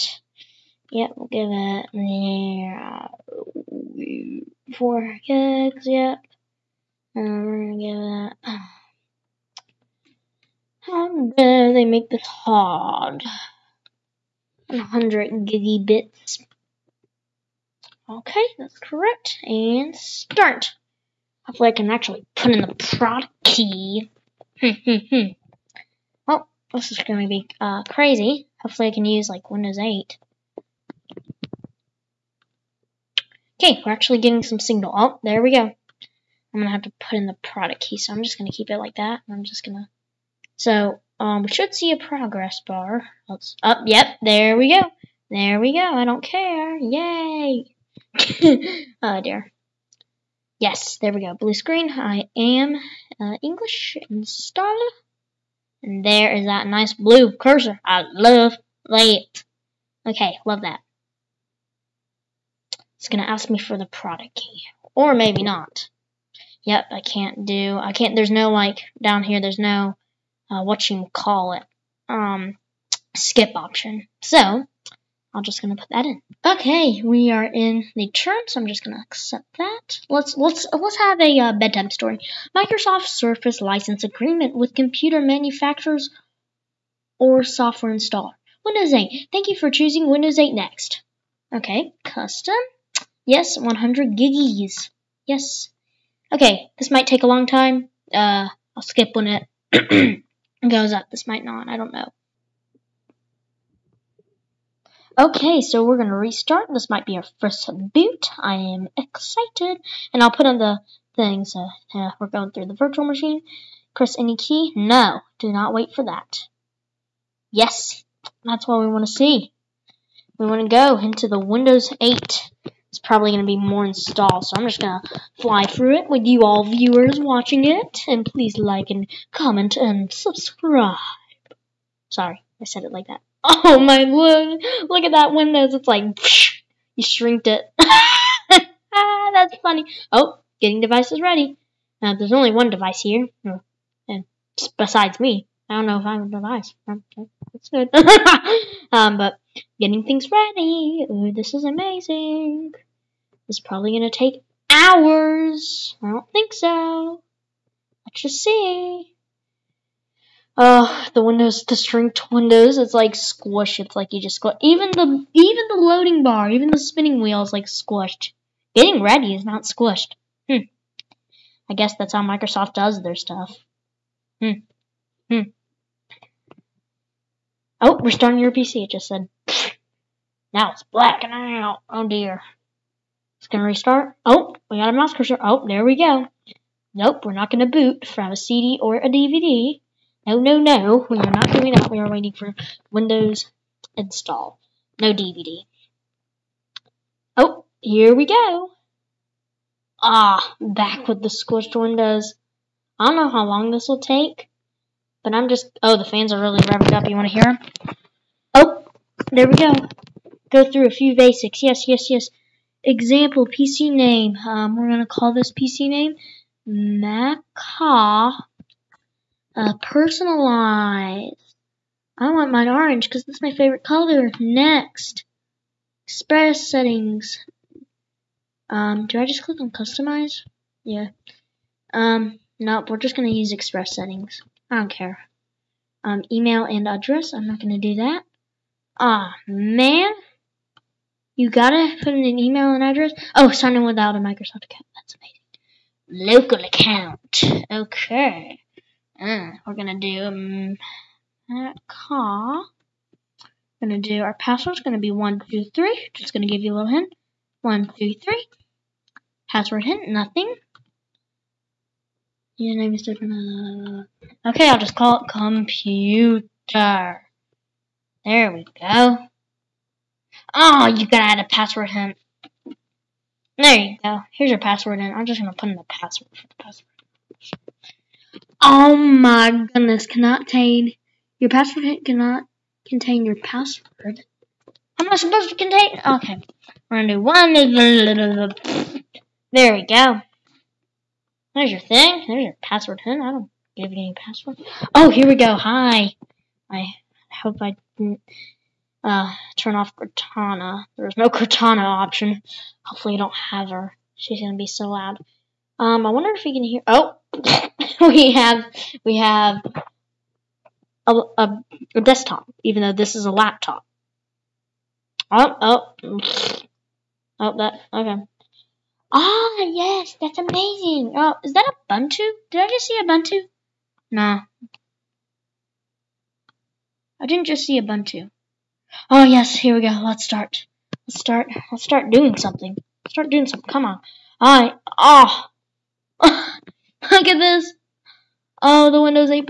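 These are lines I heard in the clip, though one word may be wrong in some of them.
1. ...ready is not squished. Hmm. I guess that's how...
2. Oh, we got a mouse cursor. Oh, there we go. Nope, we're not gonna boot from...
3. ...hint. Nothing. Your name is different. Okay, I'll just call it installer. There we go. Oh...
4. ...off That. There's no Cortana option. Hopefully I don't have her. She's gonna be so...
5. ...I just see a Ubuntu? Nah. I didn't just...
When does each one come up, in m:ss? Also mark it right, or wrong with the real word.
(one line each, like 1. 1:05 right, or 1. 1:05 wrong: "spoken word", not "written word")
1. 2:49 right
2. 3:04 right
3. 4:19 wrong: "computer", not "installer"
4. 4:59 wrong: "Cortana", not "That"
5. 5:22 right.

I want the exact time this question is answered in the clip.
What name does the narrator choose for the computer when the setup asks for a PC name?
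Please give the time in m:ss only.
3:36.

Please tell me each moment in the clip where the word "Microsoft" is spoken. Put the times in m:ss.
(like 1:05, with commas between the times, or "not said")
1:22, 2:52, 4:04.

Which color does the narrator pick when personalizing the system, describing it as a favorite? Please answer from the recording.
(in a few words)
Orange.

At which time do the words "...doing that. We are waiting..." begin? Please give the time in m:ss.
3:11.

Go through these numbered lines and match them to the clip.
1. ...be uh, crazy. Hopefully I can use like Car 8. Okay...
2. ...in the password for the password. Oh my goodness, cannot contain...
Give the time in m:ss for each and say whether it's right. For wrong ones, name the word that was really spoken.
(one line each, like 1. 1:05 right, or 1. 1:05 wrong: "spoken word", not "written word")
1. 0:27 wrong: "Windows", not "Car"
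2. 4:35 right.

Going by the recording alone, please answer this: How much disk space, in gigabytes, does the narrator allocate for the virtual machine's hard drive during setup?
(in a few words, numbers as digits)
100 gigabytes.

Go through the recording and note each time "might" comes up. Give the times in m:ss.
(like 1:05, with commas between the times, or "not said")
1:36, 1:41, 1:46.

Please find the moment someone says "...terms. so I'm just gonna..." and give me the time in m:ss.
1:18.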